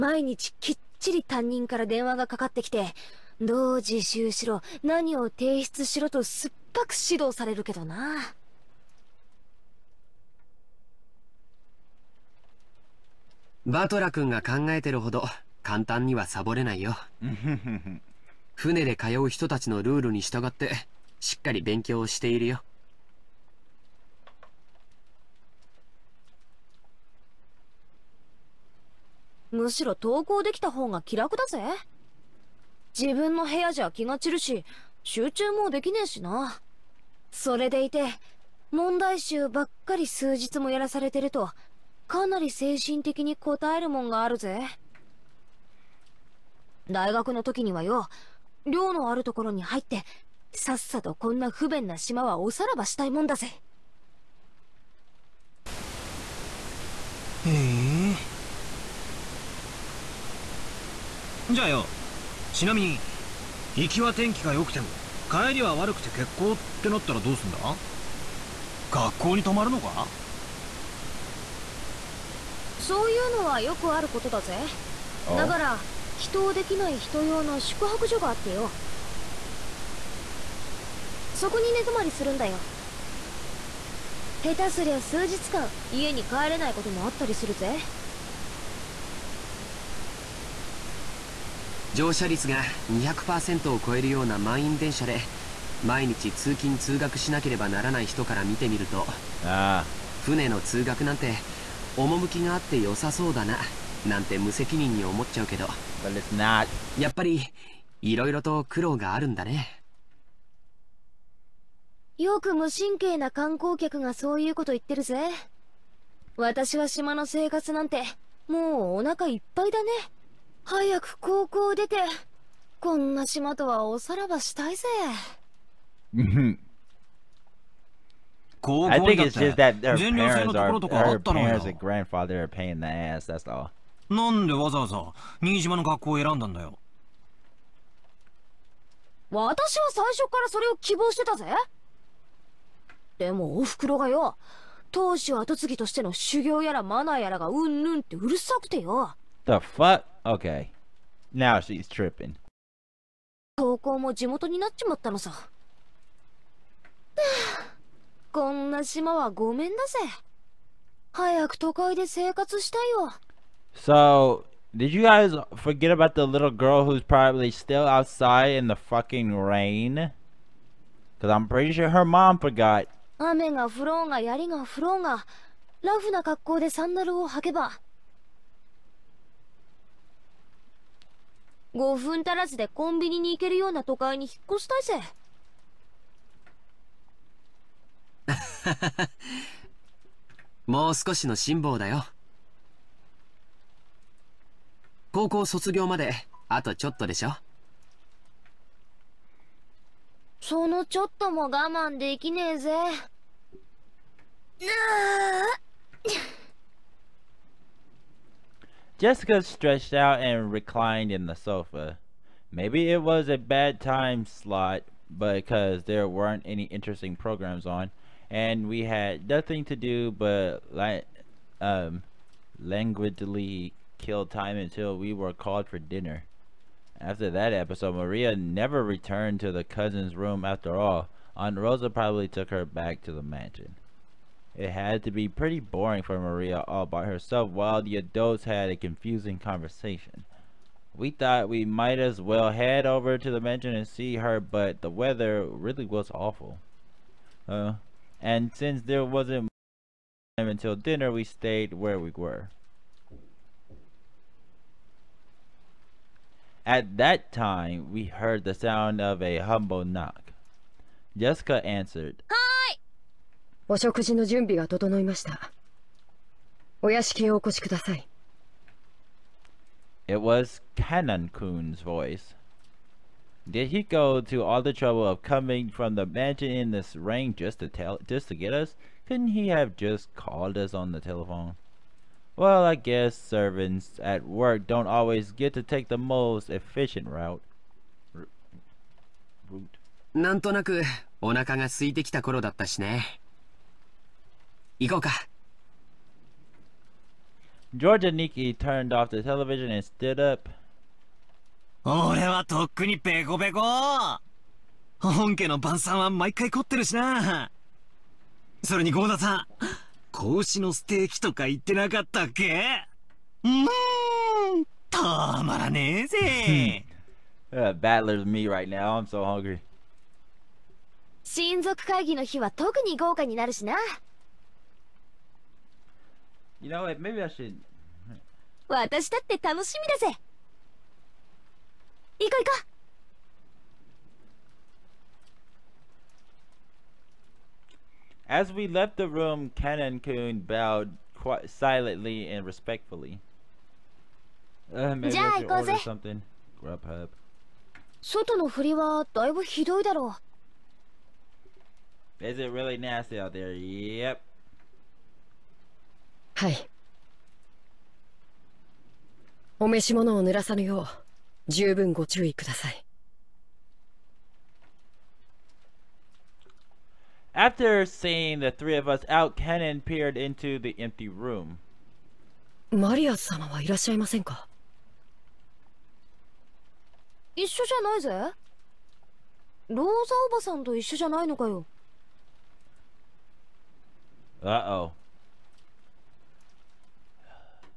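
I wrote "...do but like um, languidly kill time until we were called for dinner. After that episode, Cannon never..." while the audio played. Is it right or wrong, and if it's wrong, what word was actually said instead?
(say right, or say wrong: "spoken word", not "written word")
wrong: "Maria", not "Cannon".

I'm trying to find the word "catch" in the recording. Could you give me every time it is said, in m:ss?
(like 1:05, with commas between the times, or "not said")
not said.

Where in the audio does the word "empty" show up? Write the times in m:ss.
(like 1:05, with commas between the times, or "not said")
6:10.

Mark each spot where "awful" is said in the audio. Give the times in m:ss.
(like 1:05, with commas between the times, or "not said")
4:06.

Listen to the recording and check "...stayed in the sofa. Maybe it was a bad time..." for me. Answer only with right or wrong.
wrong.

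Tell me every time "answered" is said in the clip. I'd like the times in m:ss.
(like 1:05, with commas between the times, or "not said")
4:21.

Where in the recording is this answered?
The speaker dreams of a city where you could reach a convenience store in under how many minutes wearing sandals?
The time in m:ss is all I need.
3:01.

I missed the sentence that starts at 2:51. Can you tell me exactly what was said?
Cause I'm pretty sure her mom forgot.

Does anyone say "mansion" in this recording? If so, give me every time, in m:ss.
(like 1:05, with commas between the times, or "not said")
3:53, 4:03, 4:36.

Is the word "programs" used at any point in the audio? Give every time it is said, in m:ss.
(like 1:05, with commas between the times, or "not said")
3:37.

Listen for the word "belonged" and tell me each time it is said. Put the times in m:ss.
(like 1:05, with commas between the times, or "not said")
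not said.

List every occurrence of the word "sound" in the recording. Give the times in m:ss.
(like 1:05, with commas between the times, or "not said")
4:18.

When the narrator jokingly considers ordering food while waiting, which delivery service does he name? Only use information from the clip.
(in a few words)
Grubhub.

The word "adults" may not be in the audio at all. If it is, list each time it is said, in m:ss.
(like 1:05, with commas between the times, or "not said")
3:57.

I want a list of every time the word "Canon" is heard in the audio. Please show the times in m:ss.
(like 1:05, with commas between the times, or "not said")
4:30, 5:39.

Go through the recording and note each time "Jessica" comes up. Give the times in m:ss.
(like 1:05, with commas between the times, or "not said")
3:28, 4:21.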